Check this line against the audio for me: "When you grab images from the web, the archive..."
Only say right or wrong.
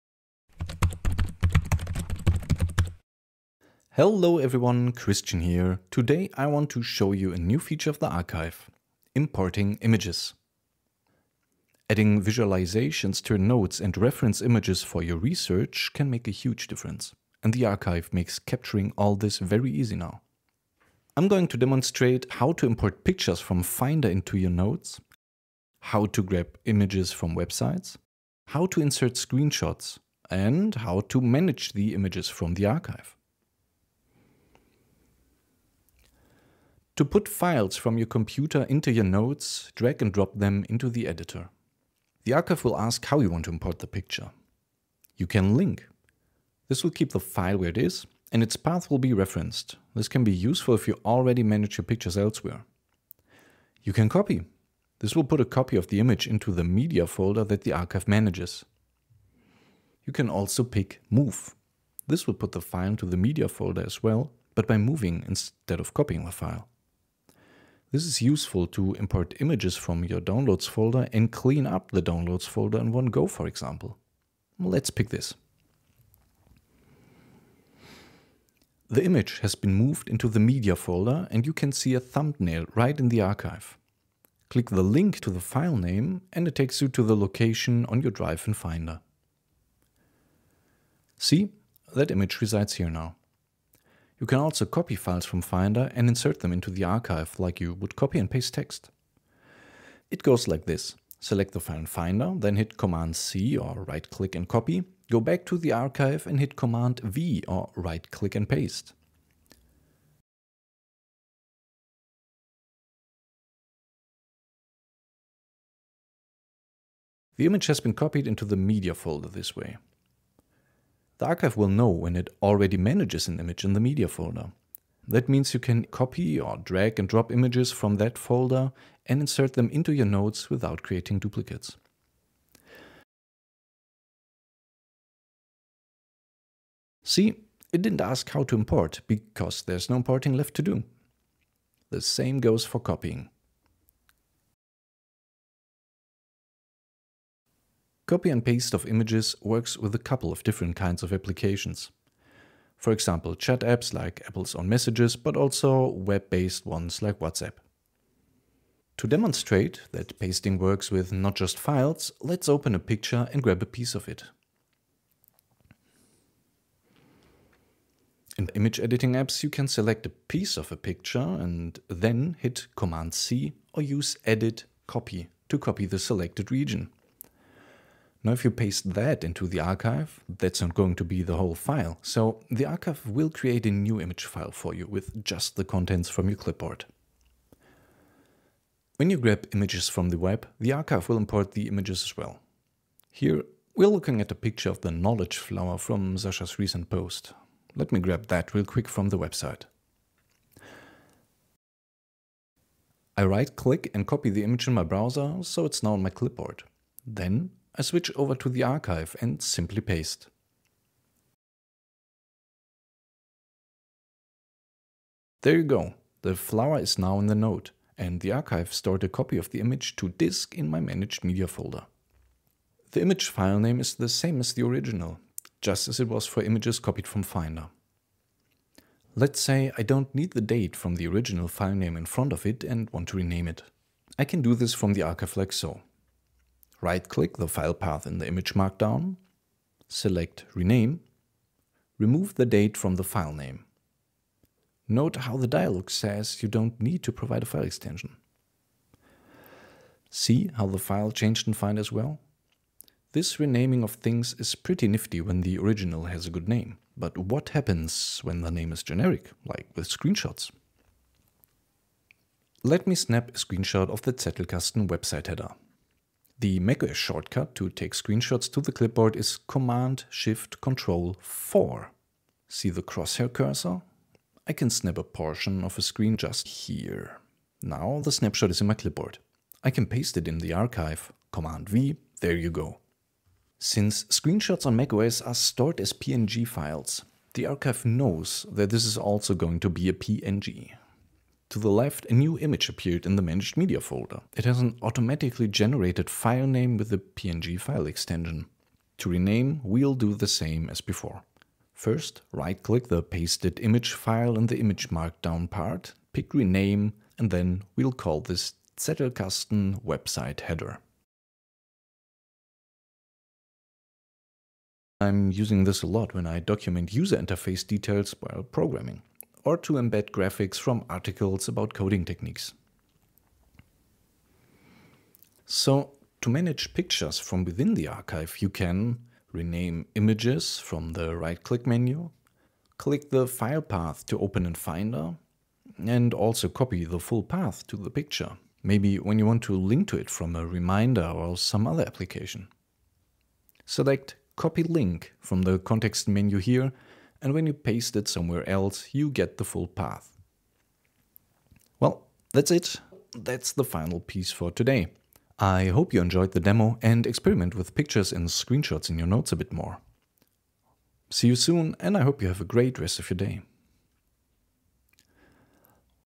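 right.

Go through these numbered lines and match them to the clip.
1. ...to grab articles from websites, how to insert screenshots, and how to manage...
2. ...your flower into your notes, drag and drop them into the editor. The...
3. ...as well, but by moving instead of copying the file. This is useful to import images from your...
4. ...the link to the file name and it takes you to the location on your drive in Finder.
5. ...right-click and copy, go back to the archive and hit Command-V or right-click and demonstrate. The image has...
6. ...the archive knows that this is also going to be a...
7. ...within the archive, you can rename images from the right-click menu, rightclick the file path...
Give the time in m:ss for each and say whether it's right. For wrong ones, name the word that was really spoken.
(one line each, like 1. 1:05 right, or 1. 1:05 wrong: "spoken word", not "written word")
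1. 0:26 wrong: "images", not "articles"
2. 0:37 wrong: "computer", not "flower"
3. 1:03 right
4. 1:24 right
5. 1:43 wrong: "paste", not "demonstrate"
6. 4:47 right
7. 5:27 wrong: "click", not "rightclick".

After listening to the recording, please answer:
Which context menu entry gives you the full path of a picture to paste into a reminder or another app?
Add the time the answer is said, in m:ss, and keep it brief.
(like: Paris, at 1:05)
Copy Link, at 5:44.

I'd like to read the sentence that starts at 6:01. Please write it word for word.
See you soon, and I hope you have a great rest of your day.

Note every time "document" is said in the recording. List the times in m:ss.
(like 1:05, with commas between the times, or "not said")
5:16.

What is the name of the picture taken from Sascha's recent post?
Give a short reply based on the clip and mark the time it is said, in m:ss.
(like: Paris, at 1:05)
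knowledge flower, at 3:14.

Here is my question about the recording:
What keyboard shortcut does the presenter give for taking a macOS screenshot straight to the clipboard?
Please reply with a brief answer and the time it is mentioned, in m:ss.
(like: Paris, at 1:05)
Command Shift Control 4, at 4:29.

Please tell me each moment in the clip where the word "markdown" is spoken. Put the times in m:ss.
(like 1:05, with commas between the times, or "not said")
3:58, 5:04.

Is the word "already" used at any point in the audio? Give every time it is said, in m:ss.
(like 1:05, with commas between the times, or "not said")
0:51, 2:02.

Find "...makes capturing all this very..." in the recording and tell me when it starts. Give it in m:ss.
0:18.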